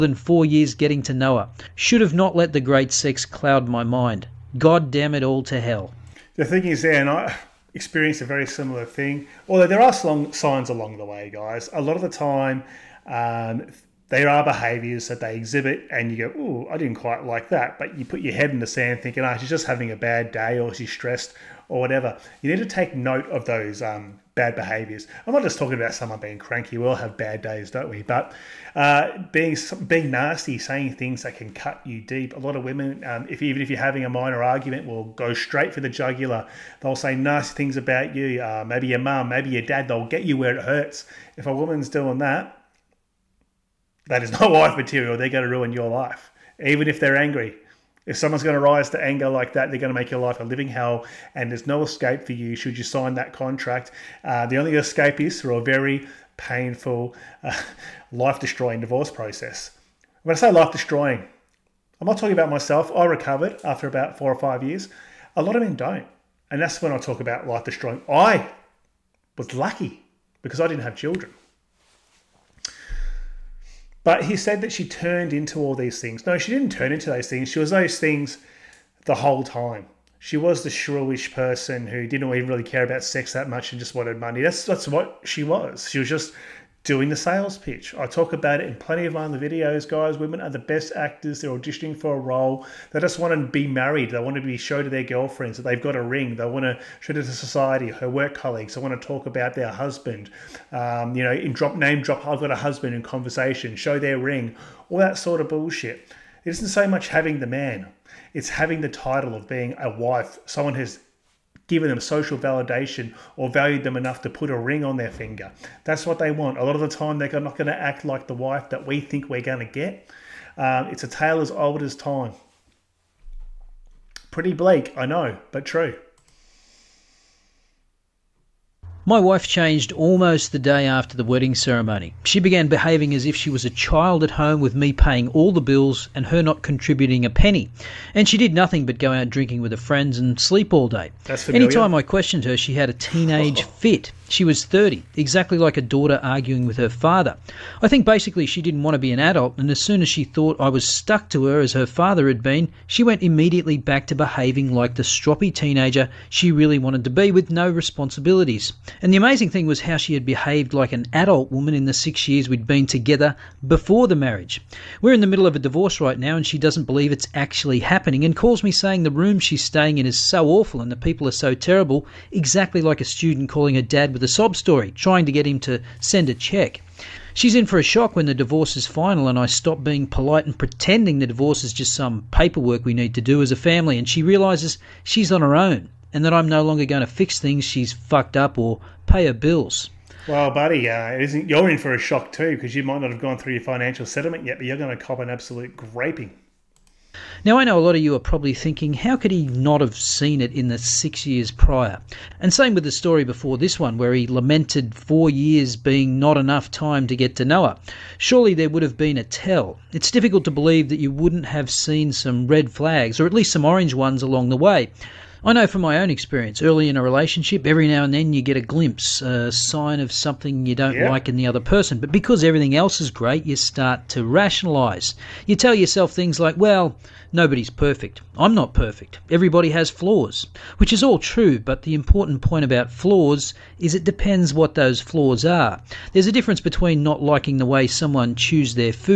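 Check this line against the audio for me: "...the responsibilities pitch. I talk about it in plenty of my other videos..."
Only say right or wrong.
wrong.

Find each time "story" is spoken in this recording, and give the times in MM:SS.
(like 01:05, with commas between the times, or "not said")
02:54, 03:22.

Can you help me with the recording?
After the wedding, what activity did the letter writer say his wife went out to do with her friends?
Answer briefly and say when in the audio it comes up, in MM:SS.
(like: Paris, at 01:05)
Drinking, at 02:19.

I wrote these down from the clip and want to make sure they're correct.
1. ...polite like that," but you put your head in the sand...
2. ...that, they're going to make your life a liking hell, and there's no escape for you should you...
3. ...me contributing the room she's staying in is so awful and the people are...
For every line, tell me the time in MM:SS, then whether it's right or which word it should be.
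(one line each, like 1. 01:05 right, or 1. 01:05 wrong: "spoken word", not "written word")
1. 00:16 wrong: "quite", not "polite"
2. 00:49 wrong: "living", not "liking"
3. 02:48 wrong: "saying", not "contributing".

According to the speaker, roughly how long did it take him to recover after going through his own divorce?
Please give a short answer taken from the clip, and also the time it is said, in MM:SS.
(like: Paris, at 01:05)
4 or 5 years, at 01:04.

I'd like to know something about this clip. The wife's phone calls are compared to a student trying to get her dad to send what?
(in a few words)
A cheque.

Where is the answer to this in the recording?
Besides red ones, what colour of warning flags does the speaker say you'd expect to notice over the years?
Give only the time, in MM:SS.
03:33.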